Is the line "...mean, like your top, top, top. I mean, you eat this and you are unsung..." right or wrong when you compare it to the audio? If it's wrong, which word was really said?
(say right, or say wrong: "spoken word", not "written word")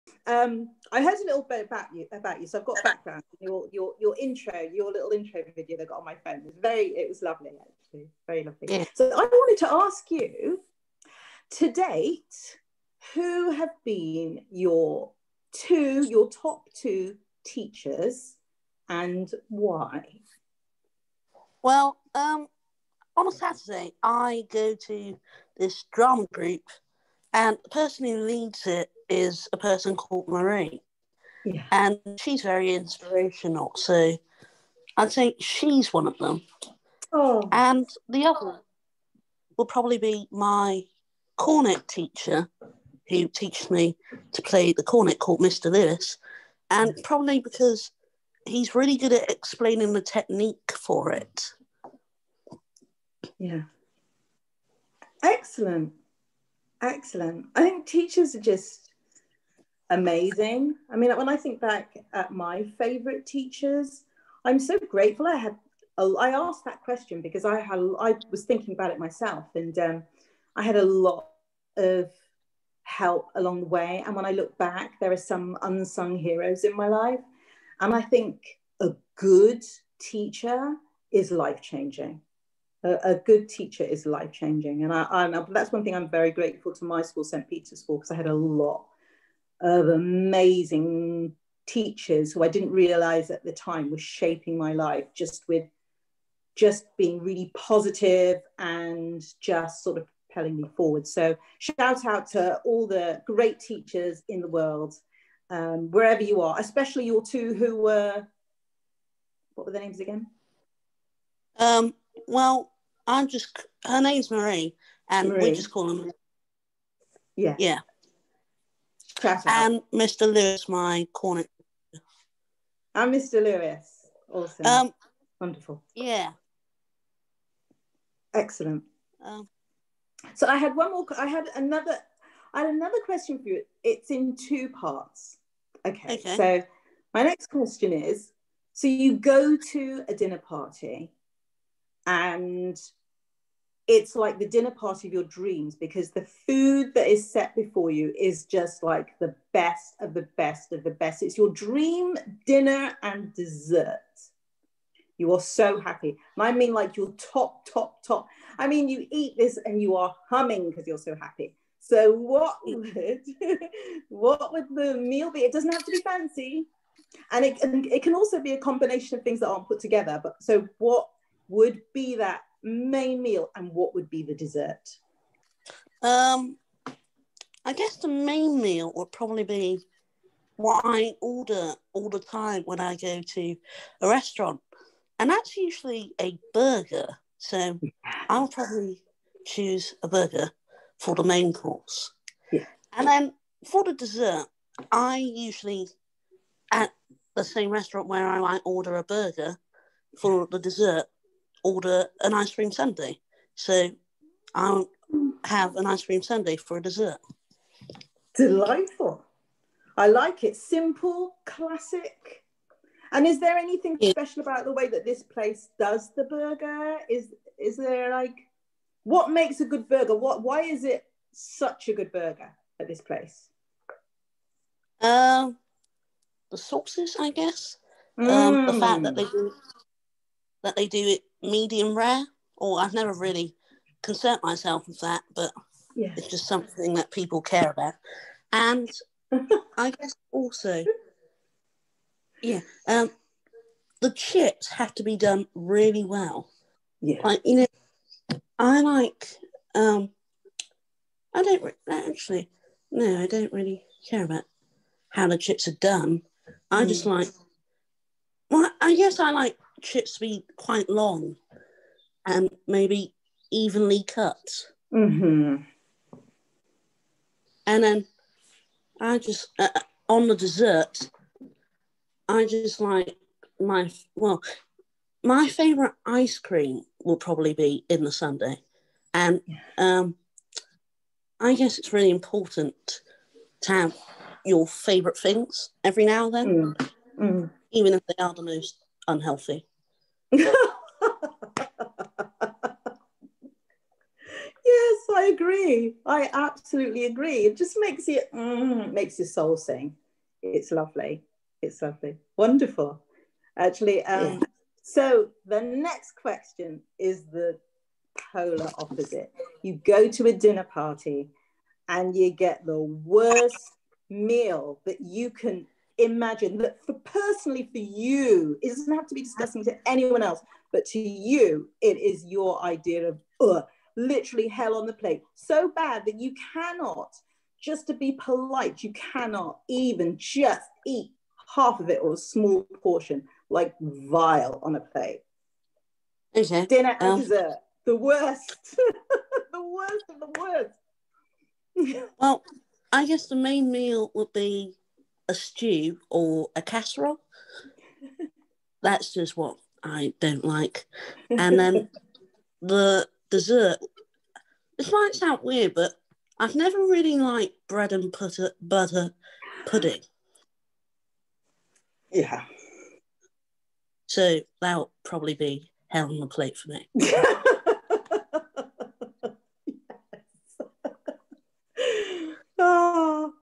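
wrong: "humming", not "unsung".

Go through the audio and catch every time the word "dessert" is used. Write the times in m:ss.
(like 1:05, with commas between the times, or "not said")
2:33, 2:54, 3:13, 3:20, 3:26, 4:30, 5:37, 5:53.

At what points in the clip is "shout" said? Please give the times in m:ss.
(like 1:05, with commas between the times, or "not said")
1:41, 1:59.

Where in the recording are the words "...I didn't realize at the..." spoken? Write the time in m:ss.
1:32.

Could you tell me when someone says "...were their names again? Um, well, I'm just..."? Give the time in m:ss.
1:49.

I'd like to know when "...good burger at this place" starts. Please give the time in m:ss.
3:41.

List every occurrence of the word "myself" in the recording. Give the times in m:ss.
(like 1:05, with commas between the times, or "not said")
1:08, 3:54.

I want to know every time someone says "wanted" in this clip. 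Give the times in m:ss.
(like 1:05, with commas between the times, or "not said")
0:09.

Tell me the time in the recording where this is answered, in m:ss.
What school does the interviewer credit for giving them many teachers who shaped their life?
1:27.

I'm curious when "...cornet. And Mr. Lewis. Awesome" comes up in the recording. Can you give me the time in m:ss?
2:01.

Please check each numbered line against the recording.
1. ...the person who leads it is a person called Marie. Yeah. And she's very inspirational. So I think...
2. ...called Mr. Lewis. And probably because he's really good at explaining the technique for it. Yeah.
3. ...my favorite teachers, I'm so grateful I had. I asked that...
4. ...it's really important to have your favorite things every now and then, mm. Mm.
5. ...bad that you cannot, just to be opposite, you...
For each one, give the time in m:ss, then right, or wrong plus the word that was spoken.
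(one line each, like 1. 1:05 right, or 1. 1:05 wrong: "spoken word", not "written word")
1. 0:27 right
2. 0:45 right
3. 1:02 right
4. 4:41 right
5. 5:25 wrong: "polite", not "opposite".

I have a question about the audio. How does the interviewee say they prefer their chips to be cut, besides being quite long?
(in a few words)
Evenly cut.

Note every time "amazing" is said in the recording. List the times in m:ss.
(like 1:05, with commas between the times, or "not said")
0:59, 1:29.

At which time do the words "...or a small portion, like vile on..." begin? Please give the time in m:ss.
5:32.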